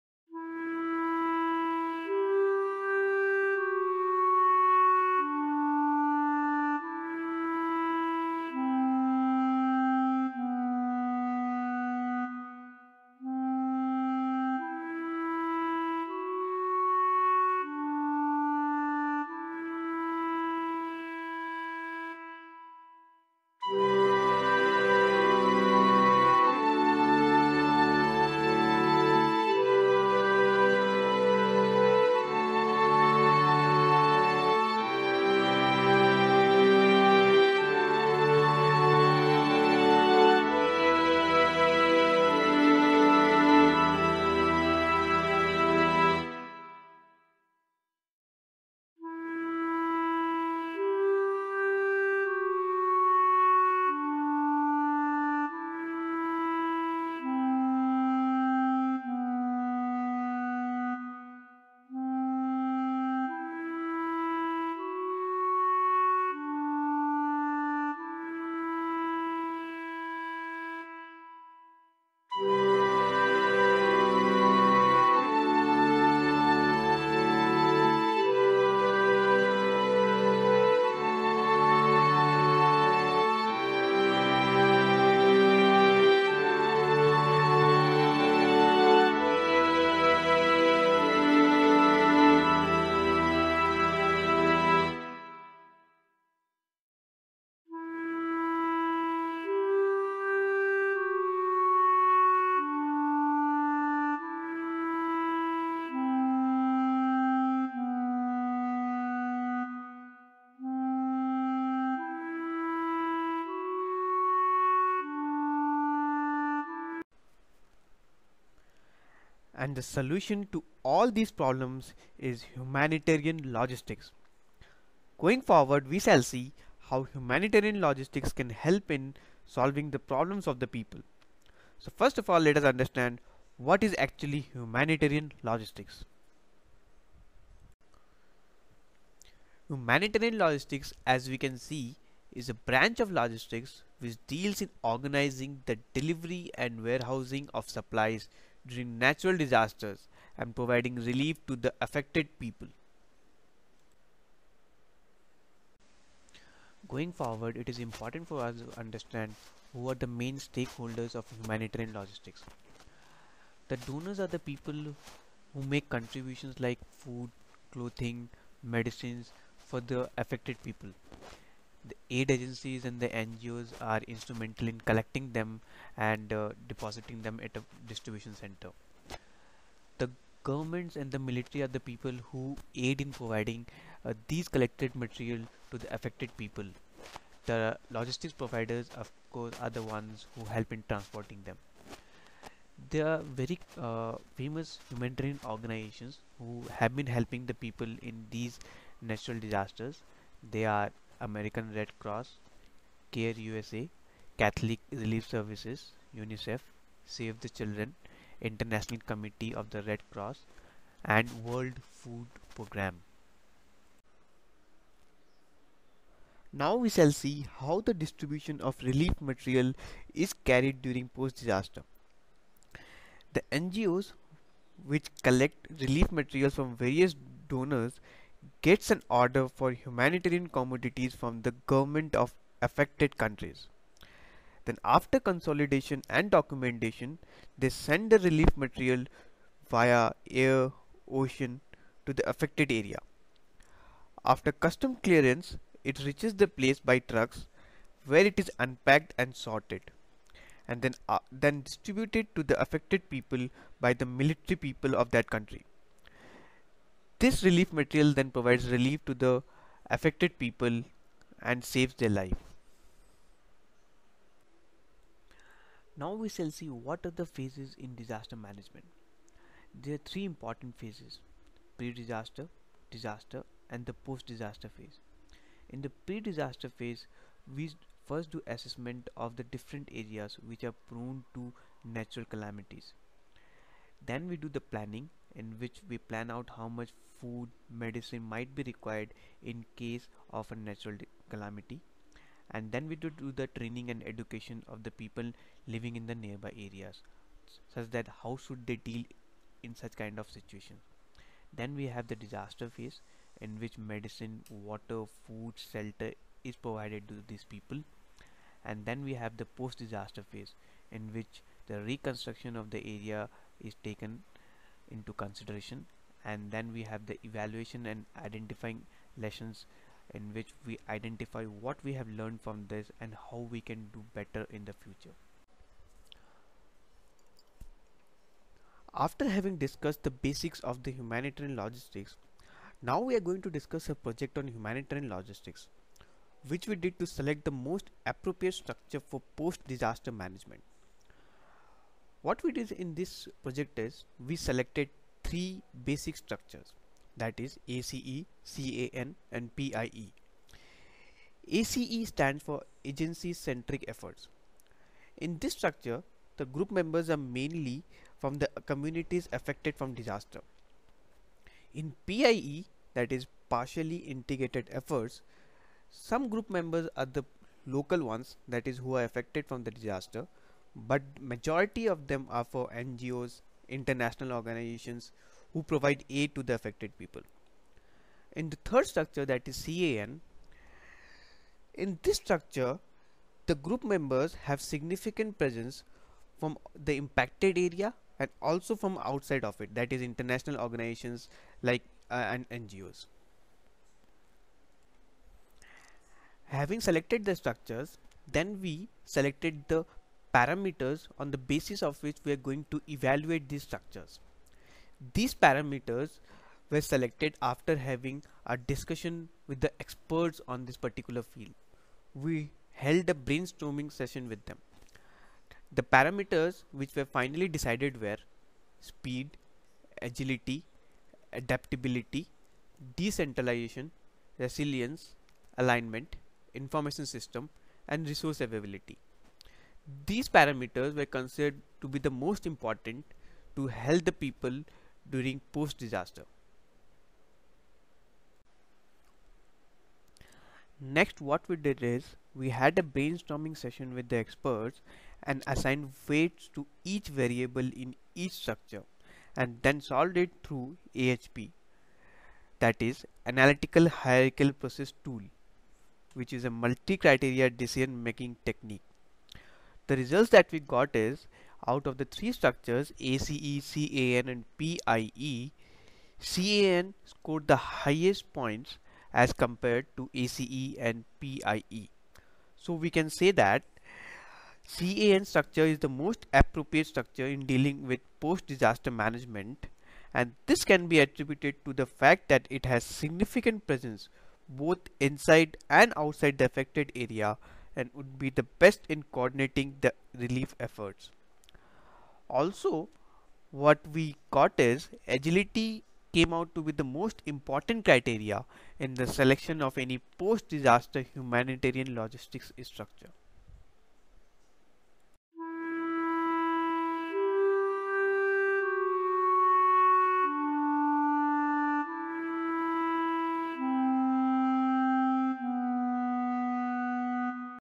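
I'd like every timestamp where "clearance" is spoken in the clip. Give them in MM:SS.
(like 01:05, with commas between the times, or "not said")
04:04.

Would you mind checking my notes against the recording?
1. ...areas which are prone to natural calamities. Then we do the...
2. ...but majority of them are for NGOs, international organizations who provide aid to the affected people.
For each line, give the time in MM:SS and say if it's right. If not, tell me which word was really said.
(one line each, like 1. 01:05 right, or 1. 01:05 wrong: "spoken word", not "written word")
1. 04:39 right
2. 06:10 right.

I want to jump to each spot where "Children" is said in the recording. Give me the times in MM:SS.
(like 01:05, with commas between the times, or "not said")
03:27.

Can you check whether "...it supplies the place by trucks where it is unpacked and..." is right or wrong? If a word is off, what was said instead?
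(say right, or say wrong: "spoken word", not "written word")
wrong: "reaches", not "supplies".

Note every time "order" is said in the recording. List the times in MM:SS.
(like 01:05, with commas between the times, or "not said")
03:49.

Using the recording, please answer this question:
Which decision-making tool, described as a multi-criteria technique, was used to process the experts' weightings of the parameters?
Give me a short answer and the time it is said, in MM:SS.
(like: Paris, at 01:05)
analytical hierarchical process, at 07:33.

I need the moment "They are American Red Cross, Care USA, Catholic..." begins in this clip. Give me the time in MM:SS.
03:20.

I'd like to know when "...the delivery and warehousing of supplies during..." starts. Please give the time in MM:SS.
02:25.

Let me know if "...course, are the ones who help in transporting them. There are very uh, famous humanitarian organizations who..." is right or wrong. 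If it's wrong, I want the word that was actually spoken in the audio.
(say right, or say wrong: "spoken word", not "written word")
right.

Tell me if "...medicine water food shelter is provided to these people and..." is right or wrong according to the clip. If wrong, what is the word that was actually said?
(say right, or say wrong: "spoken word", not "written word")
right.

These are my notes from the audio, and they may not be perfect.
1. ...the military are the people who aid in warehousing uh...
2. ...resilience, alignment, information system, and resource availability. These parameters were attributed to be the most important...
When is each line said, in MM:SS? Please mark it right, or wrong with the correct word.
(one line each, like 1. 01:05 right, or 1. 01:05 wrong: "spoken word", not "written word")
1. 03:01 wrong: "providing", not "warehousing"
2. 07:04 wrong: "considered", not "attributed".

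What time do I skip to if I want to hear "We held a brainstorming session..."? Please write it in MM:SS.
06:52.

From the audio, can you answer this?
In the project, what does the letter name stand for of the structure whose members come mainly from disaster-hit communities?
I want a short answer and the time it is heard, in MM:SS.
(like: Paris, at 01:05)
agency centric efforts, at 05:52.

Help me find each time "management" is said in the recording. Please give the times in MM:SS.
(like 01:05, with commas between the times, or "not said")
04:28, 05:40, 07:58.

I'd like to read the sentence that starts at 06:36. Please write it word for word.
Having selected the structures then we selected the parameters on the basis of which we are going to evaluate these structures.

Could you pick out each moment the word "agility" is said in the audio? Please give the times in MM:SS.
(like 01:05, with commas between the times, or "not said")
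07:00, 08:15.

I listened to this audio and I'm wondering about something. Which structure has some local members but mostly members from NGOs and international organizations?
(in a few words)
partially integrated efforts.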